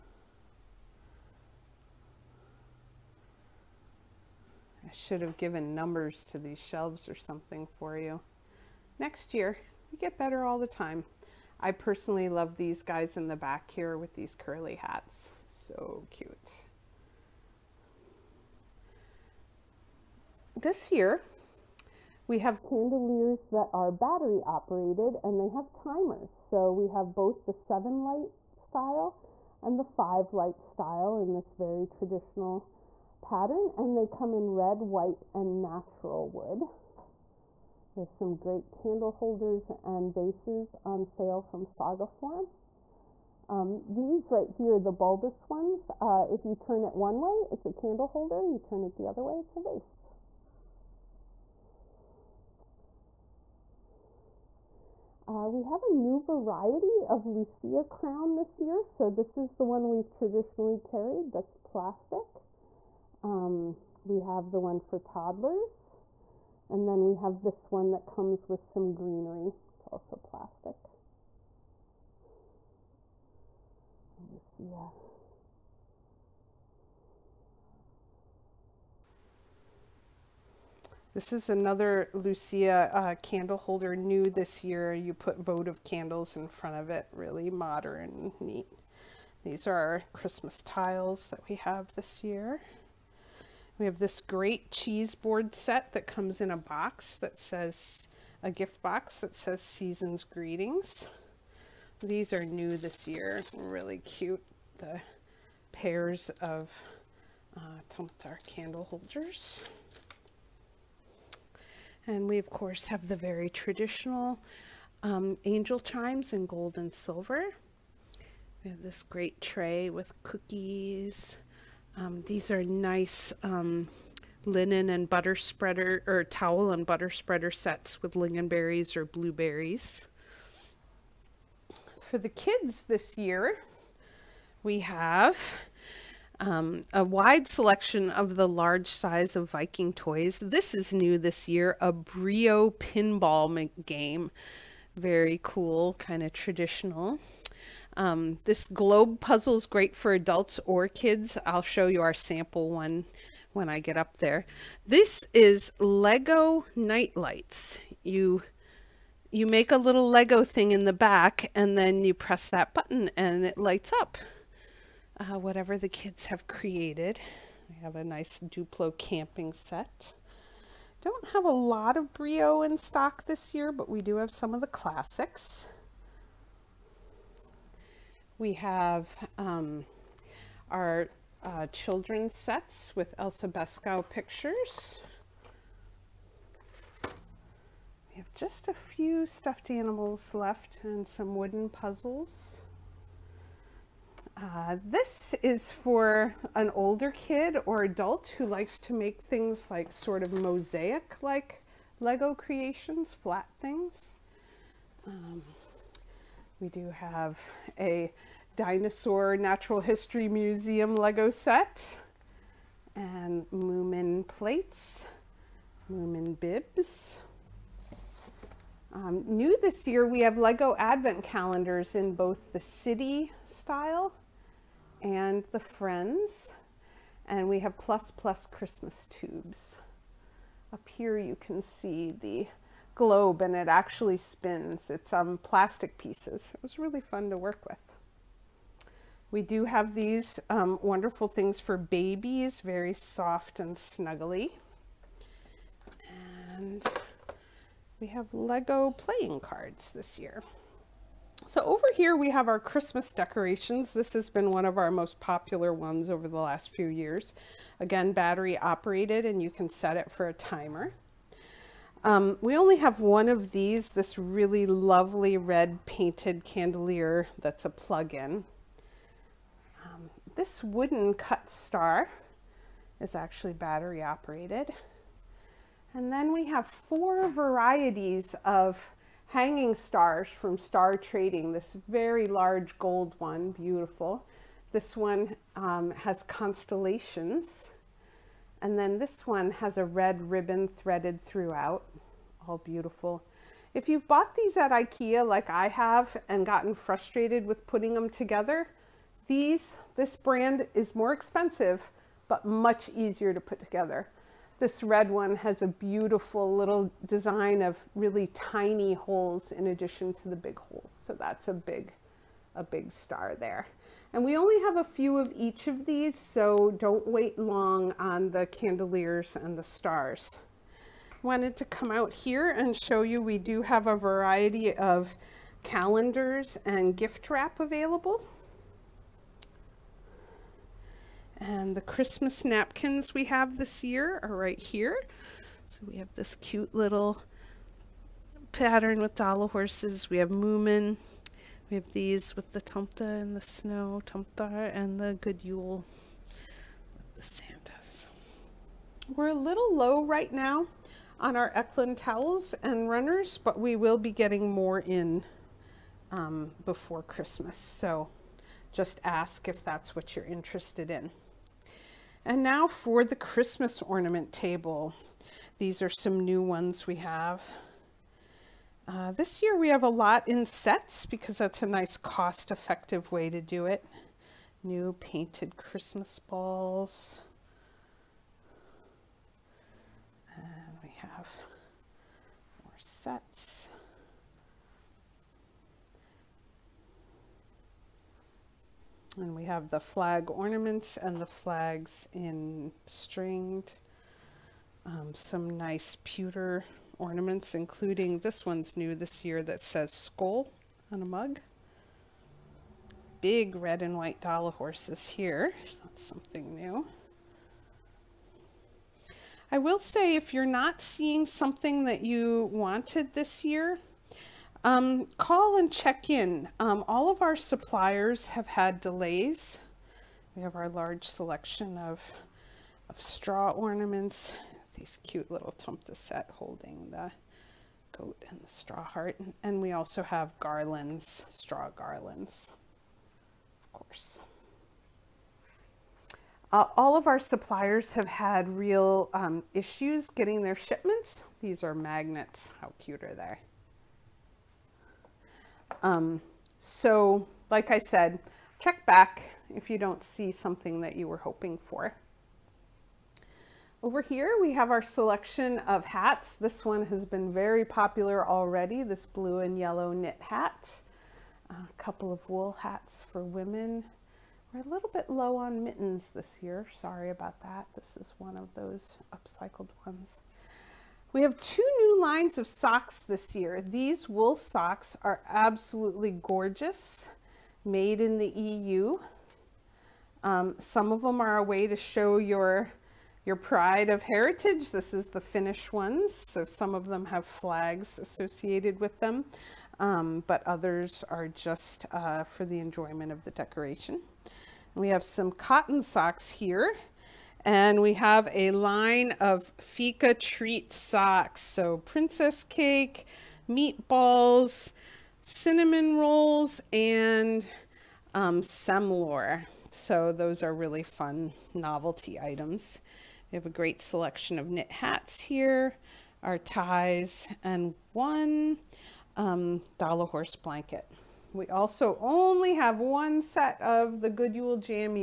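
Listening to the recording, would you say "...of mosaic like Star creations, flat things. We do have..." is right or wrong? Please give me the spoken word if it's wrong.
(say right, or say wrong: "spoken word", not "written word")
wrong: "Lego", not "Star".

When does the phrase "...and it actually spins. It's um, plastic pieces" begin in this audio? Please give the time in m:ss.
3:53.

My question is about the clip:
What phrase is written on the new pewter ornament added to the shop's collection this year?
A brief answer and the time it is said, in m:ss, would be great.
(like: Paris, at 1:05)
skull on a mug, at 6:39.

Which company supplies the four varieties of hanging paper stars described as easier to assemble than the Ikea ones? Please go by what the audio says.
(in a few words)
Star Trading.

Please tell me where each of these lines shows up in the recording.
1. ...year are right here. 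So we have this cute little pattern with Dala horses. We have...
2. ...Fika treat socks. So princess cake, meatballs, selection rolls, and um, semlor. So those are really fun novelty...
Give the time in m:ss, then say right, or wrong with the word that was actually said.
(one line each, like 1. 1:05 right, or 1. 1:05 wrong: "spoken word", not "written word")
1. 5:33 right
2. 8:19 wrong: "cinnamon", not "selection".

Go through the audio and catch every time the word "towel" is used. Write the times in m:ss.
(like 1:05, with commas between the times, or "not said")
2:06, 5:51.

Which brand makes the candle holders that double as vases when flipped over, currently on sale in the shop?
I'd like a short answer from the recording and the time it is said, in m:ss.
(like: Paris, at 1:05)
Sagaform, at 0:41.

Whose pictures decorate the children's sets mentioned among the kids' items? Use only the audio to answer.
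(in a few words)
Elsa Beskow.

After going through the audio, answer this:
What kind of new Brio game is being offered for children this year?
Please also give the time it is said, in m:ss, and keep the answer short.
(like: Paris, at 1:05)
pinball game, at 2:22.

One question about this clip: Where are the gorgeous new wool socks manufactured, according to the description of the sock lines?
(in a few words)
the EU.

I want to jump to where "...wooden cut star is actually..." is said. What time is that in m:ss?
4:30.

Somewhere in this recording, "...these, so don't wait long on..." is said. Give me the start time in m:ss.
5:15.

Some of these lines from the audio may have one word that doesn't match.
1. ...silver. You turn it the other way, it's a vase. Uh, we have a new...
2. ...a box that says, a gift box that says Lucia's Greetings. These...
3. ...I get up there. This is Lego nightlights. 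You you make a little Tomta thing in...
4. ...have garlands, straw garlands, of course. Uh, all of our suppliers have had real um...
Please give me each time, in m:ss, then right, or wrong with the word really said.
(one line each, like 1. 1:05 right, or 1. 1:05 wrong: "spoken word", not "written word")
1. 0:48 wrong: "holder", not "silver"
2. 1:36 wrong: "Season", not "Lucia"
3. 2:33 wrong: "Lego", not "Tomta"
4. 7:10 right.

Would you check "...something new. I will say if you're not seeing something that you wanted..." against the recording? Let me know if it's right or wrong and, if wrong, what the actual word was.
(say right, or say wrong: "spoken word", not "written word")
right.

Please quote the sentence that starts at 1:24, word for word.
You put votive candles in front of it.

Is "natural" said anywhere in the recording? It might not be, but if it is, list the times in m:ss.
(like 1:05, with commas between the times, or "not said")
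0:35, 3:29.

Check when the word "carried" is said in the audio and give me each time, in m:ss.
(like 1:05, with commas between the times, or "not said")
1:00.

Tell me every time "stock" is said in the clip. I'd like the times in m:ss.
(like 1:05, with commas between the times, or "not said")
2:52.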